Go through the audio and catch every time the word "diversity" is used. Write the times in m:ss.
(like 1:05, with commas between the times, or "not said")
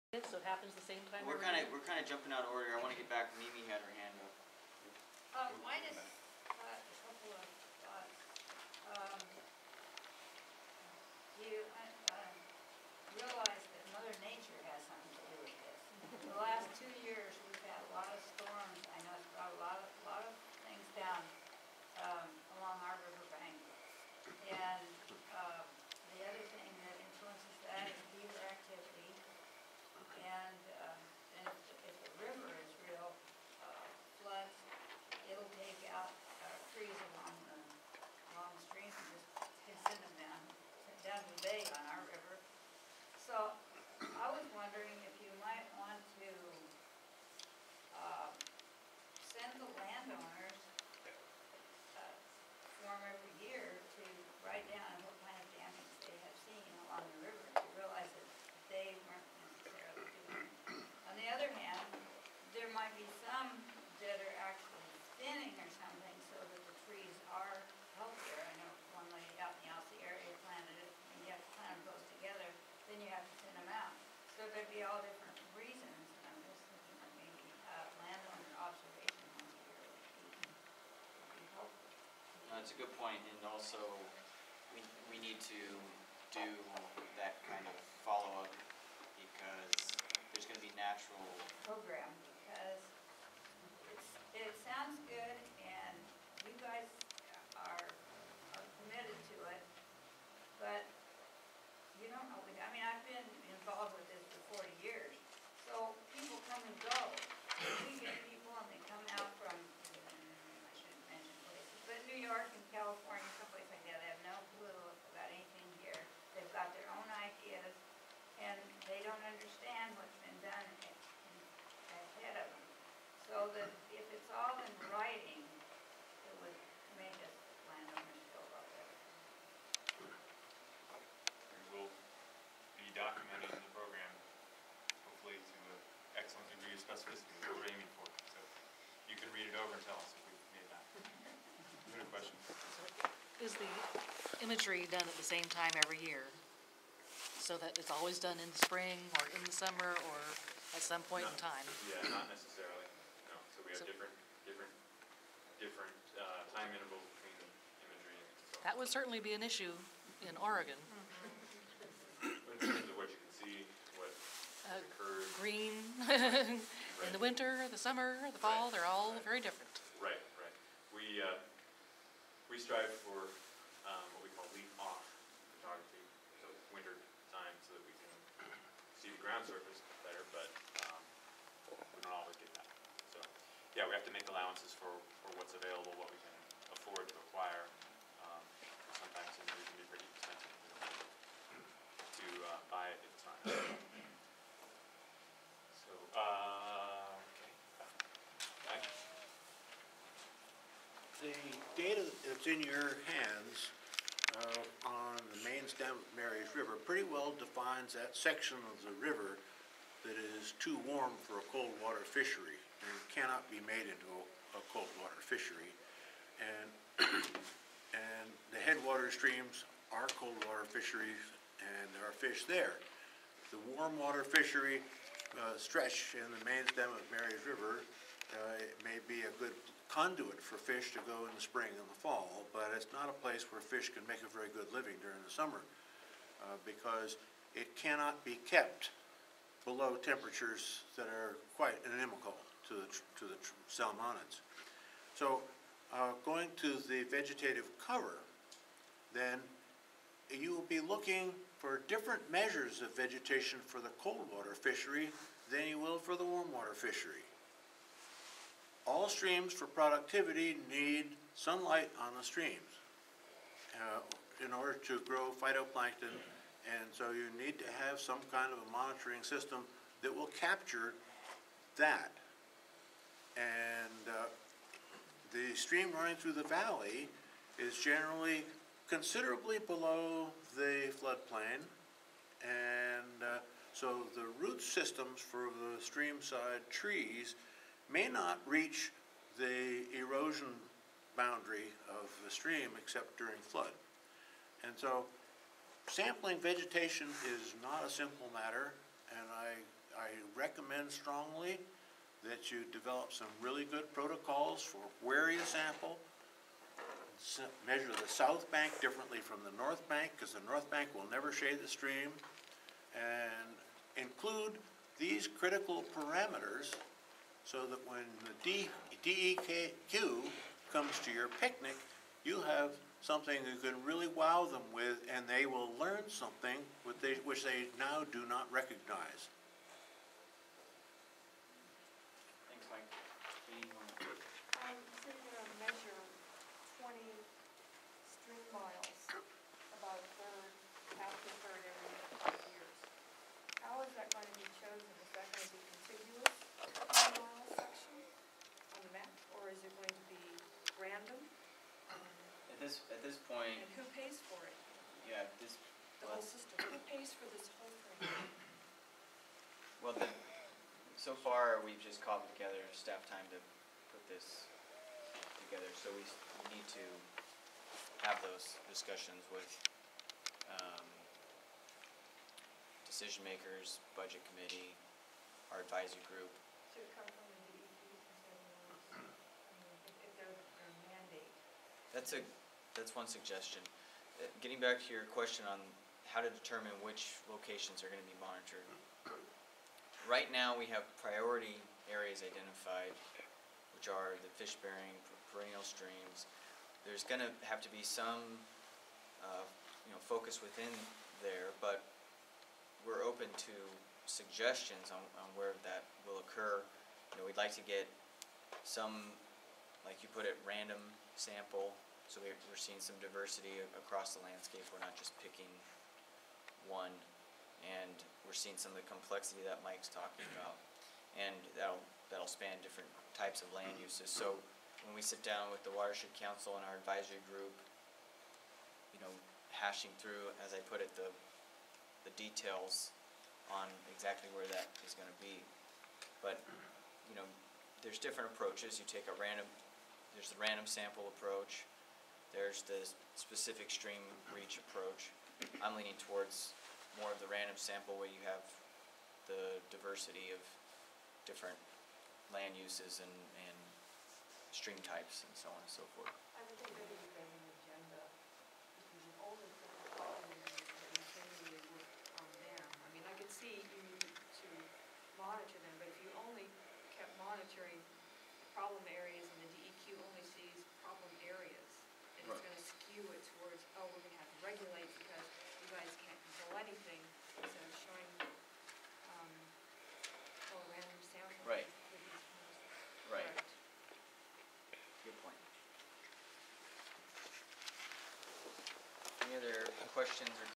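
6:52, 7:29.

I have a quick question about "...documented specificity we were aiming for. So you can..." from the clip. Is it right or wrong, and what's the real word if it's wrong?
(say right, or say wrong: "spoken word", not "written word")
right.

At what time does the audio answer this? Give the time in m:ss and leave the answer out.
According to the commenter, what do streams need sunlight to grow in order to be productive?
4:25.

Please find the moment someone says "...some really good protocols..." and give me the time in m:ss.
5:03.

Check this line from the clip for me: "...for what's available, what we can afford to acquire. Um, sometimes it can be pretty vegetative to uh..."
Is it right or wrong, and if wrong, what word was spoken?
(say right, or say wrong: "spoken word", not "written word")
wrong: "expensive", not "vegetative".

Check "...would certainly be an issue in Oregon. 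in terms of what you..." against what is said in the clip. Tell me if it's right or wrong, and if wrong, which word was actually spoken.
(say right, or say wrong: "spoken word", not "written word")
right.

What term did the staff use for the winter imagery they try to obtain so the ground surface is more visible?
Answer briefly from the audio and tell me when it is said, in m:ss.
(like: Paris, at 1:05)
leaf off photography, at 2:54.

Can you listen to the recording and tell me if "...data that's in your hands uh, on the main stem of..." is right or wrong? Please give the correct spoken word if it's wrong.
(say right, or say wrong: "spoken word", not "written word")
right.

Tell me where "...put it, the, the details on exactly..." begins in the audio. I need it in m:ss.
7:10.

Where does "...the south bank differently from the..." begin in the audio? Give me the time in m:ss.
5:08.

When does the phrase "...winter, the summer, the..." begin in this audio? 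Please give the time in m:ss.
2:47.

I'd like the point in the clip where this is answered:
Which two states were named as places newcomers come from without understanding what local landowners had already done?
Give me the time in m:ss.
1:52.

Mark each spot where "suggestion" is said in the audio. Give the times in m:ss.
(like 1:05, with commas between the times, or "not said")
6:23, 6:44.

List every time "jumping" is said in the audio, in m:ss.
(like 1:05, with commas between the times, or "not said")
0:02.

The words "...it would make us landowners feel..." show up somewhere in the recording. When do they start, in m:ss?
2:05.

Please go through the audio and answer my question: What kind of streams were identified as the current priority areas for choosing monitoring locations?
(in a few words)
fish-bearing perennial streams.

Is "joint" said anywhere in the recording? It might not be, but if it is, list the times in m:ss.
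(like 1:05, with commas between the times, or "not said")
not said.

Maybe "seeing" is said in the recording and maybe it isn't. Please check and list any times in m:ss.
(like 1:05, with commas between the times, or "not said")
6:52, 6:58.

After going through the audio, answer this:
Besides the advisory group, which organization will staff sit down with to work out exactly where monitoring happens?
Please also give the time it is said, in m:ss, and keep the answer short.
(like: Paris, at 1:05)
Watershed Council, at 7:05.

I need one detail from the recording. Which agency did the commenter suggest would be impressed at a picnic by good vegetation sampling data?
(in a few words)
DEQ.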